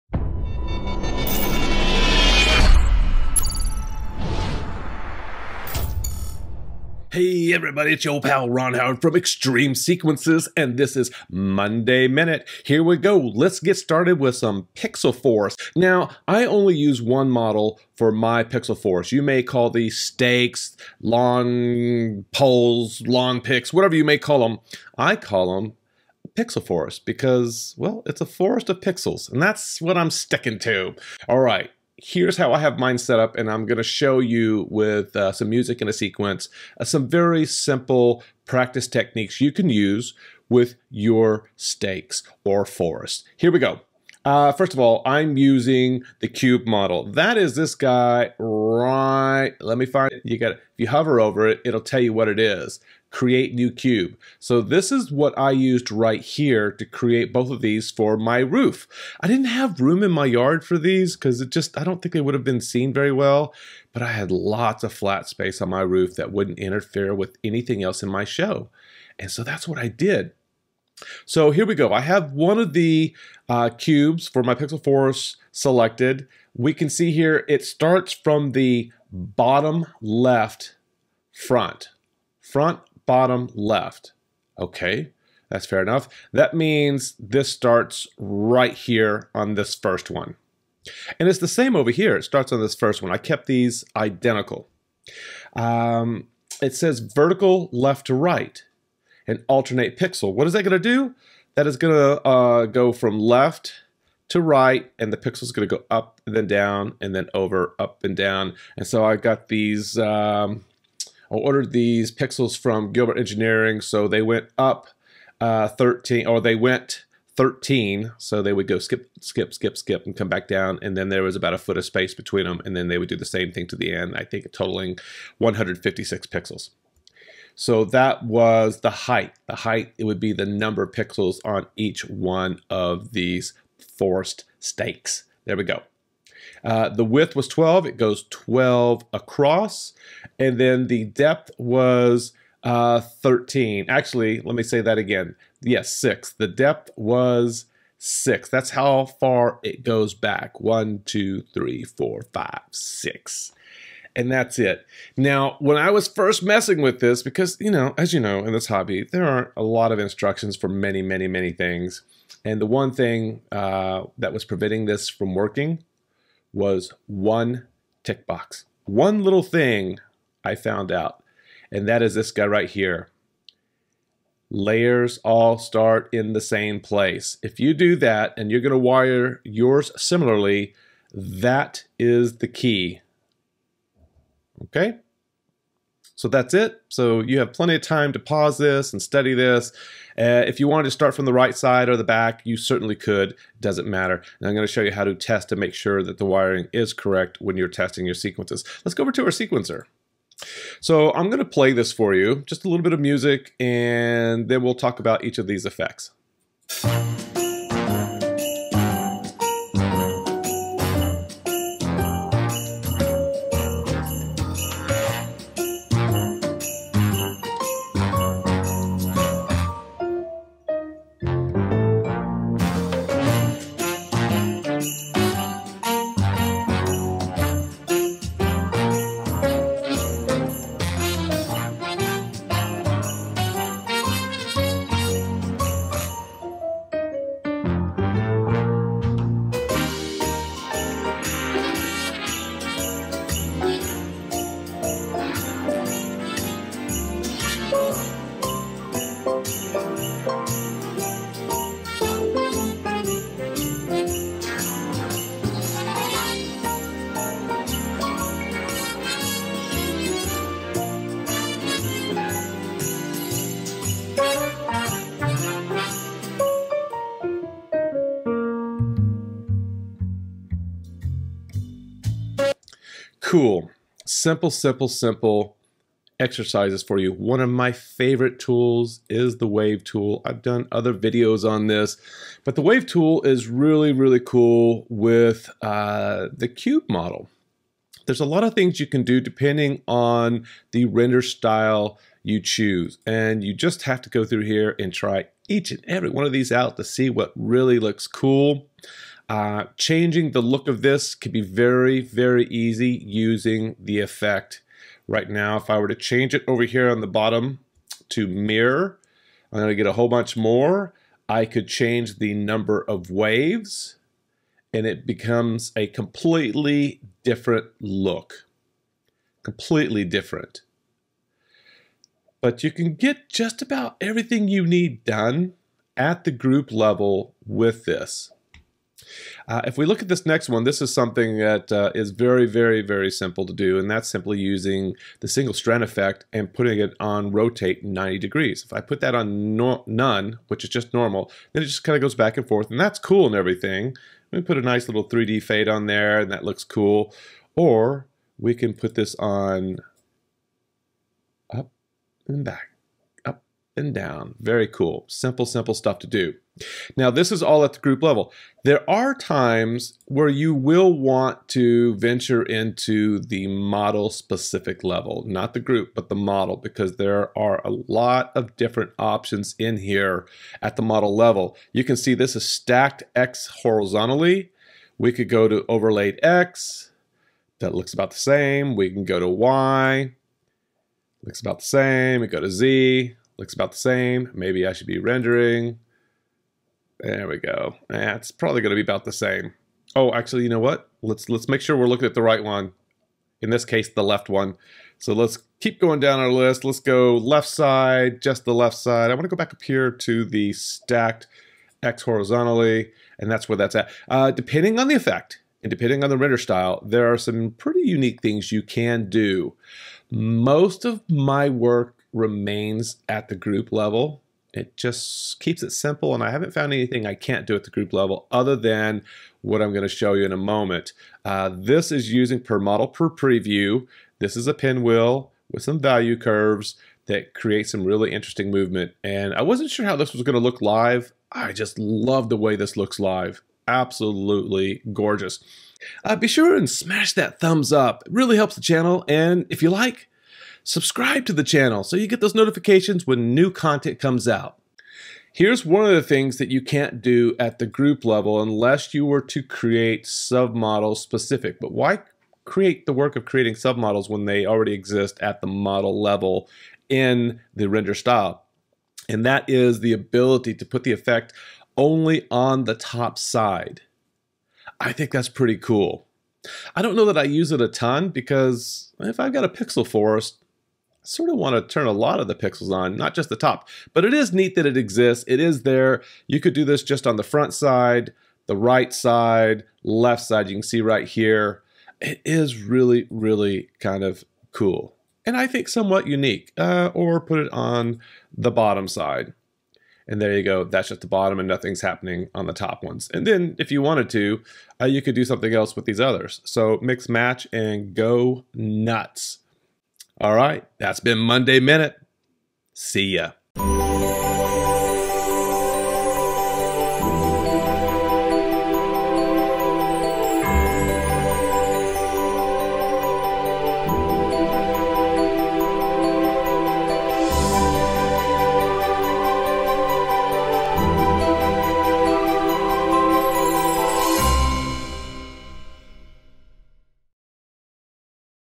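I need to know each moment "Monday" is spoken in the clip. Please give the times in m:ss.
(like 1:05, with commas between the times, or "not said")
0:11, 8:21.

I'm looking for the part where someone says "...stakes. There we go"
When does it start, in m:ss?
2:14.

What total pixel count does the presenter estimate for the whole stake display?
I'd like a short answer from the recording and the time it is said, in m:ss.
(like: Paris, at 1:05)
156, at 2:05.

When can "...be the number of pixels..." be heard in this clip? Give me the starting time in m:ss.
2:10.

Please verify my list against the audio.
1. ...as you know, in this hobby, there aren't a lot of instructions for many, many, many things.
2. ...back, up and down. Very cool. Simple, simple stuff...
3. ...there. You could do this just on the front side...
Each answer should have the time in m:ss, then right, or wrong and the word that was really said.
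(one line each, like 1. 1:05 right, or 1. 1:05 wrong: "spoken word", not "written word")
1. 2:37 right
2. 5:52 right
3. 7:55 right.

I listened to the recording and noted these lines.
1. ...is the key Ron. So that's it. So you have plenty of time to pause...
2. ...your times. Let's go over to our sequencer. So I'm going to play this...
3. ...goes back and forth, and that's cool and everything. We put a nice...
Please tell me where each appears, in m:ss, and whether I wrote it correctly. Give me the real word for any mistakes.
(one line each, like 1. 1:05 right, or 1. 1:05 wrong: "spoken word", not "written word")
1. 3:01 wrong: "Okay", not "Ron"
2. 3:18 wrong: "sequences", not "times"
3. 5:42 right.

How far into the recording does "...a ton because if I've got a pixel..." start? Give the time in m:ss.
7:47.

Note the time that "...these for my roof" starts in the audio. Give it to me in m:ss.
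0:57.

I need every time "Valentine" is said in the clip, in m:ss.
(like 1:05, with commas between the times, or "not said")
not said.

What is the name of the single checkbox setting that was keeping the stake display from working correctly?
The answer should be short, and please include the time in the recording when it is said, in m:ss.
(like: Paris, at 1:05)
Layers all start in the same place, at 2:54.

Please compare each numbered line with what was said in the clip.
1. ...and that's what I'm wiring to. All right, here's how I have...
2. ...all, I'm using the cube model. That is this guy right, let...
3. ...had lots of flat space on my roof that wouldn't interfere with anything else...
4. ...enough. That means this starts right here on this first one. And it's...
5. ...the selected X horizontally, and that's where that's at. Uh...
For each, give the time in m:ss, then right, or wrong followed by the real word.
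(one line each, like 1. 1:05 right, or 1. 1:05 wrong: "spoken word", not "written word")
1. 0:29 wrong: "sticking", not "wiring"
2. 0:44 right
3. 1:04 right
4. 1:25 right
5. 6:40 wrong: "stacked", not "selected".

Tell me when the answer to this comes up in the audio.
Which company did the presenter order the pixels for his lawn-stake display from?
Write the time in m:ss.
1:52.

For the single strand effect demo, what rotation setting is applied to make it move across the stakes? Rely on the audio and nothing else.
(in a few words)
rotate 90 degrees.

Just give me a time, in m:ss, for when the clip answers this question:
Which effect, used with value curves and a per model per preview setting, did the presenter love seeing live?
7:04.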